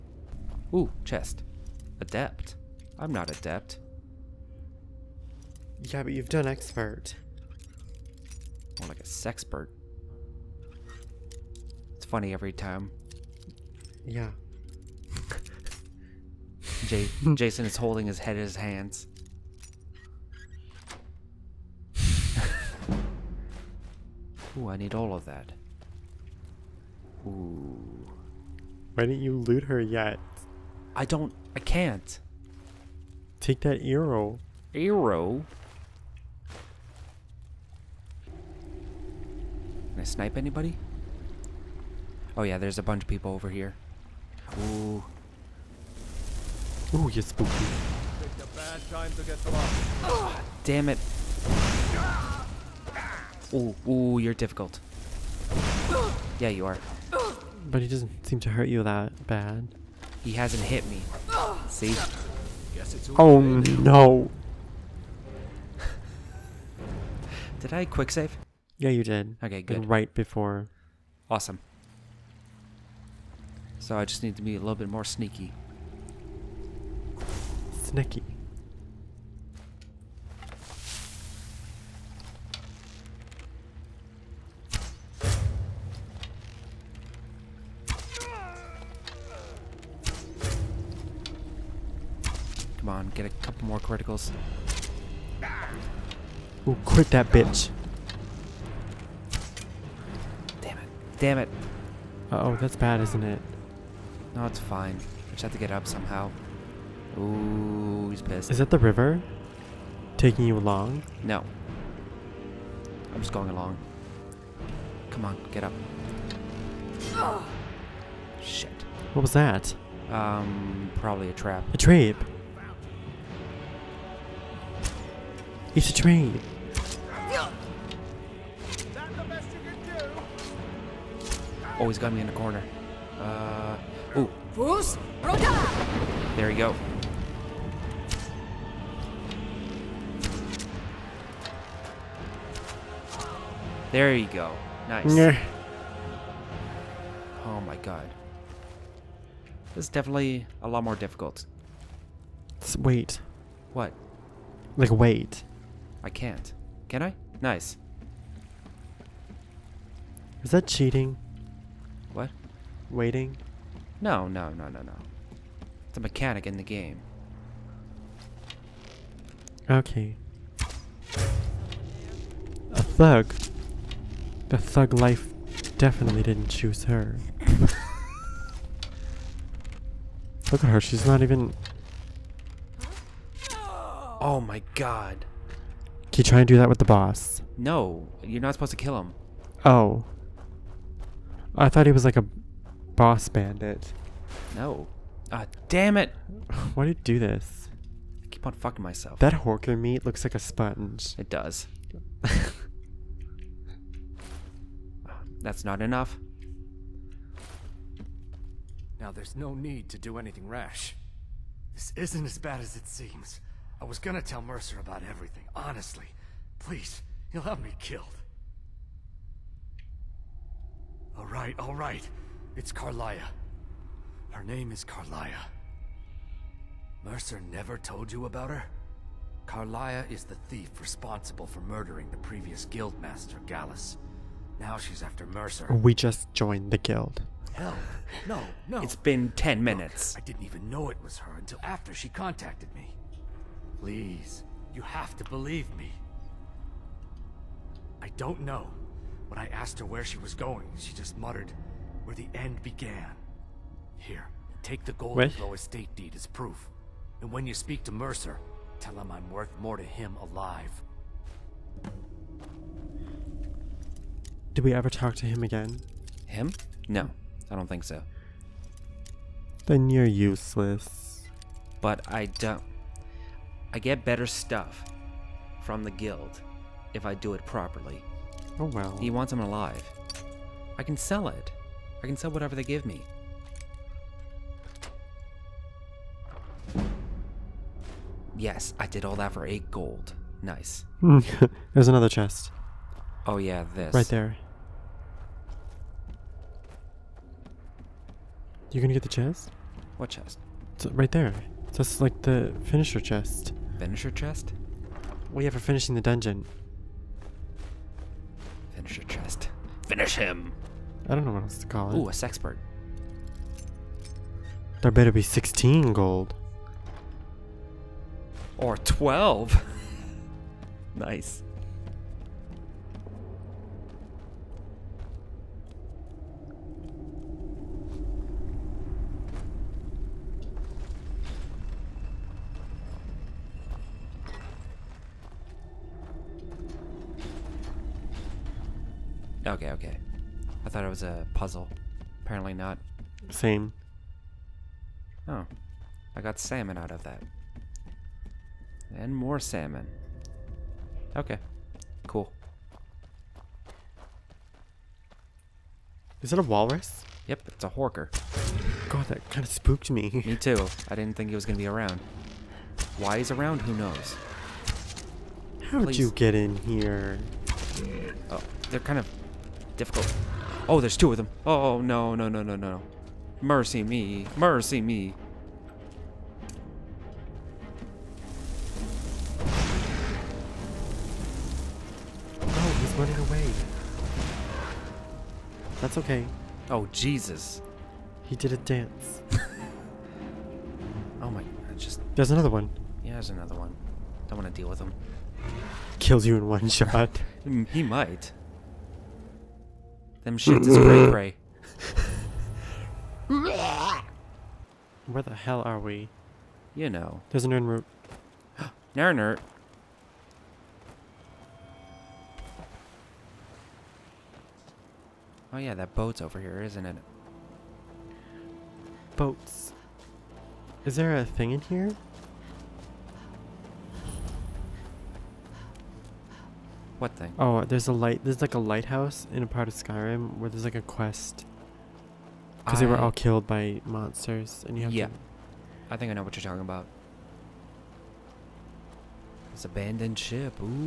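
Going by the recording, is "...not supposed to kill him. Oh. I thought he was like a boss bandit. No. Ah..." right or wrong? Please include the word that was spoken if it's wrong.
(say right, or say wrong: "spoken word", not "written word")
right.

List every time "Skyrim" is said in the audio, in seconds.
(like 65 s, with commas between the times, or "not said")
429 s.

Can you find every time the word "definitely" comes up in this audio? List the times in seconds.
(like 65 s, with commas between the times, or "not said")
149 s, 175 s.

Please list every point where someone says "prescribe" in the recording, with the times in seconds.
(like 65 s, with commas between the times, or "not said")
not said.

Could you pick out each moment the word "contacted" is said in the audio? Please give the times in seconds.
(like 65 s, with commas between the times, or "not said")
242 s.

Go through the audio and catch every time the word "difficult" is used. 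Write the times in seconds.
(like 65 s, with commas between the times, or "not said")
54 s, 150 s, 369 s.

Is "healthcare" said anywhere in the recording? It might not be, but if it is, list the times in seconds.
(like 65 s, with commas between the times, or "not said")
not said.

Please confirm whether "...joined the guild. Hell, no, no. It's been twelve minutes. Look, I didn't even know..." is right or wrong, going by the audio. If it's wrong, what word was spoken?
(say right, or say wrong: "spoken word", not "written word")
wrong: "ten", not "twelve".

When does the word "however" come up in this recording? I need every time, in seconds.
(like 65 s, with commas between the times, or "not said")
not said.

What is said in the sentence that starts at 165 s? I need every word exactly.
It's a mechanic in the game.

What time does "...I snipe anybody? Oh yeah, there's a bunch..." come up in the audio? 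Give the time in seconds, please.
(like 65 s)
39 s.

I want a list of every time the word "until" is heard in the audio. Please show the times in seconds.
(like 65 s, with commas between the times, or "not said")
241 s.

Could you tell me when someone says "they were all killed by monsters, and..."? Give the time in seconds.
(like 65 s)
432 s.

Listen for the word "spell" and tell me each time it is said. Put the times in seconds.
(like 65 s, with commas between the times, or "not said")
not said.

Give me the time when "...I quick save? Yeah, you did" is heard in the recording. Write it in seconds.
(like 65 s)
67 s.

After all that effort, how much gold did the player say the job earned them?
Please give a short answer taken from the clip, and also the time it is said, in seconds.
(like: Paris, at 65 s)
8 gold, at 289 s.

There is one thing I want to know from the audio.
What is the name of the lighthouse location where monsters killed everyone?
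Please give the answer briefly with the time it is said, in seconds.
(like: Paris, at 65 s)
Abandoned ship, at 439 s.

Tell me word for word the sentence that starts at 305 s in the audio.
Well, yeah, for finishing the dungeon.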